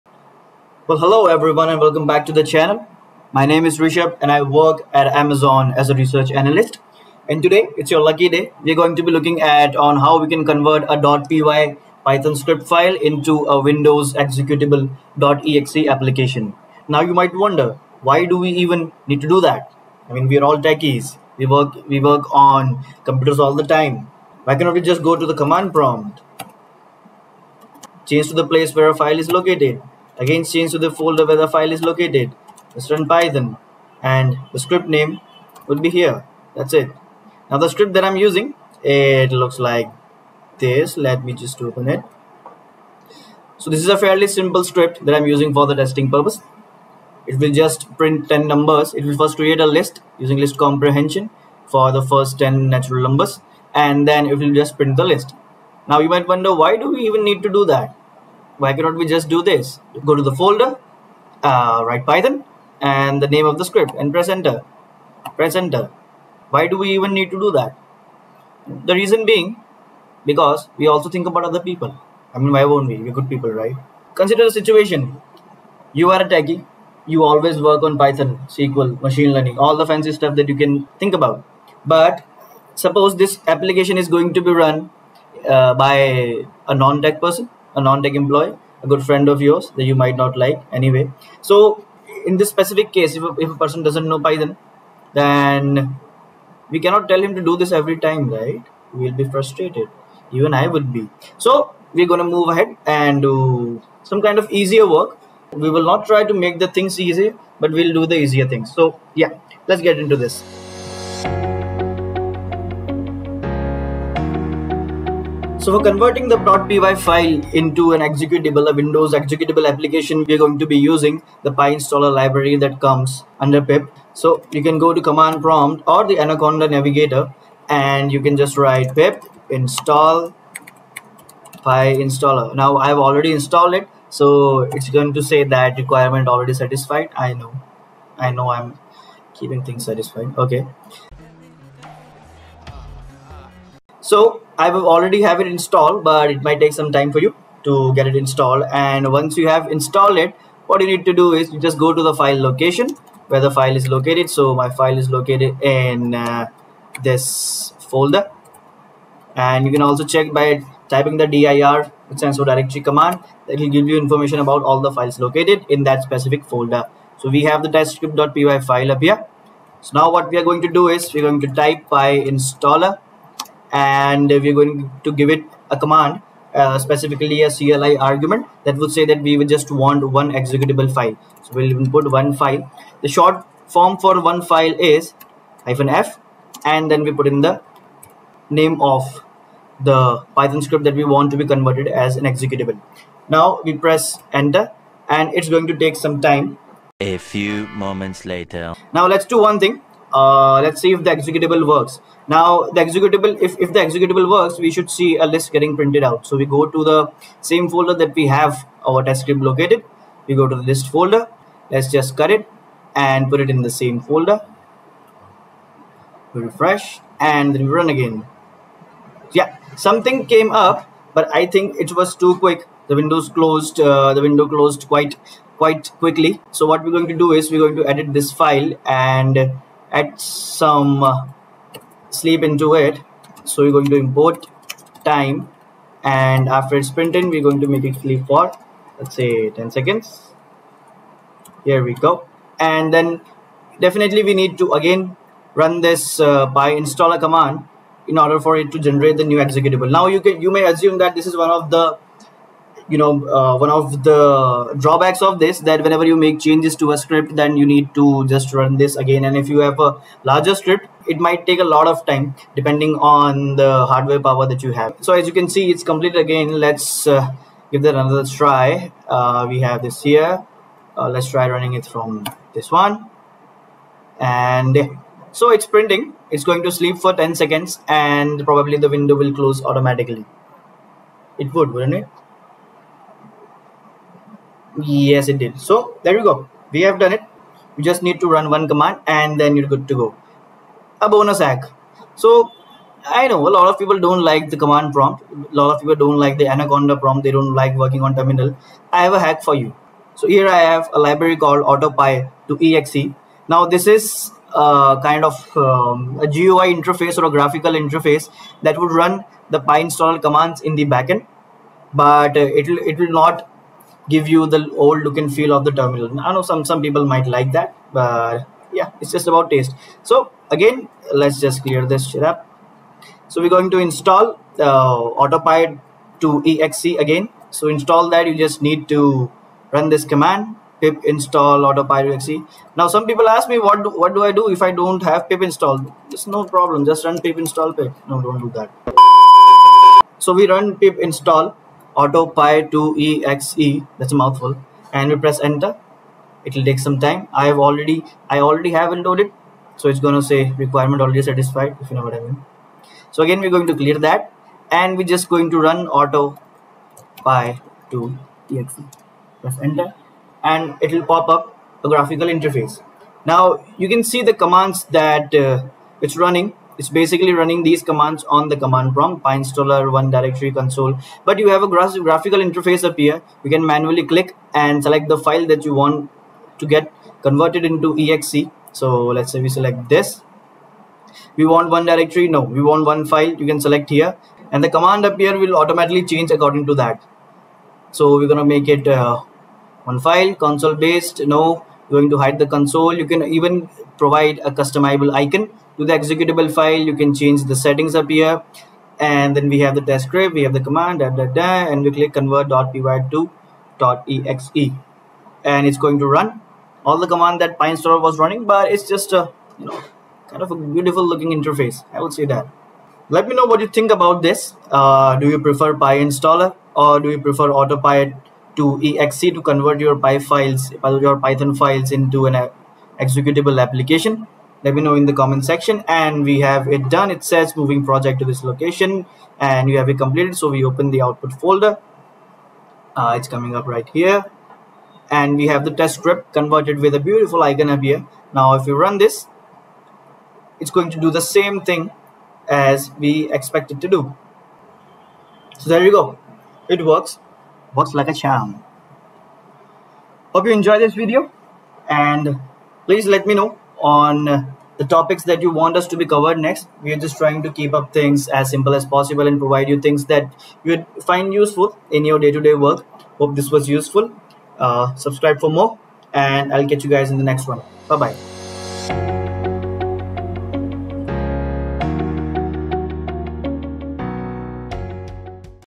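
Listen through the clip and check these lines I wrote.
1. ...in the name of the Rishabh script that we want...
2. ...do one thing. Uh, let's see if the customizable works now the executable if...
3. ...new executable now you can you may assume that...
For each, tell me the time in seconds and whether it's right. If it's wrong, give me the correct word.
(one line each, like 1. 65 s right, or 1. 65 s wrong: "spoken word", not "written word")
1. 187 s wrong: "Python", not "Rishabh"
2. 199 s wrong: "executable", not "customizable"
3. 249 s right.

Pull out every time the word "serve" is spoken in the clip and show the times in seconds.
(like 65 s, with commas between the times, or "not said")
not said.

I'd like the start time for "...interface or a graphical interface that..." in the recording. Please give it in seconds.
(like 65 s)
306 s.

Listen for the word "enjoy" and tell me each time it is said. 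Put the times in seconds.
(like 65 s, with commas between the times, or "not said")
450 s.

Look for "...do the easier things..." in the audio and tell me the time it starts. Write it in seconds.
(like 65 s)
107 s.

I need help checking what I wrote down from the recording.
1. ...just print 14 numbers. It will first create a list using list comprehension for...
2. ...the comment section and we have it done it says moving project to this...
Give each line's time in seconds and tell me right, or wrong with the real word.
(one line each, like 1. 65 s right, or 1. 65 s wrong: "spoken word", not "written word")
1. 47 s wrong: "10", not "14"
2. 425 s right.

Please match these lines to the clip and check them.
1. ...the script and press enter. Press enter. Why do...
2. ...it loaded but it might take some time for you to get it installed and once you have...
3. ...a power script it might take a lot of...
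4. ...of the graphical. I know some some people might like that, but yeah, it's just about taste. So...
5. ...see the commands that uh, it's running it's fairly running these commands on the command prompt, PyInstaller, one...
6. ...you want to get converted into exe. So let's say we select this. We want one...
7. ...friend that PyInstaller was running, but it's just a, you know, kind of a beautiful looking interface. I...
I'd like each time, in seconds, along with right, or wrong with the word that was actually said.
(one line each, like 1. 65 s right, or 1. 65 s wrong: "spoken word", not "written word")
1. 63 s right
2. 145 s wrong: "installed", not "loaded"
3. 259 s wrong: "larger", not "power"
4. 315 s wrong: "terminal", not "graphical"
5. 364 s wrong: "basically", not "fairly"
6. 375 s right
7. 407 s wrong: "command", not "friend".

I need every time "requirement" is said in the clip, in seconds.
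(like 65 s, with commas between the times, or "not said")
135 s, 350 s.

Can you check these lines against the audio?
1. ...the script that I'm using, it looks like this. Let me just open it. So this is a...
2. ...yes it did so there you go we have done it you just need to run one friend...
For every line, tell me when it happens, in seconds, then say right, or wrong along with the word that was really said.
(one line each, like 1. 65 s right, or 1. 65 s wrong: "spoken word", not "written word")
1. 37 s right
2. 284 s wrong: "command", not "friend".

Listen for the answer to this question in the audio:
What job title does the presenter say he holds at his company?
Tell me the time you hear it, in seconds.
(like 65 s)
5 s.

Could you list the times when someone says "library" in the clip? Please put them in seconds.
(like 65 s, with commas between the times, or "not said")
122 s, 300 s.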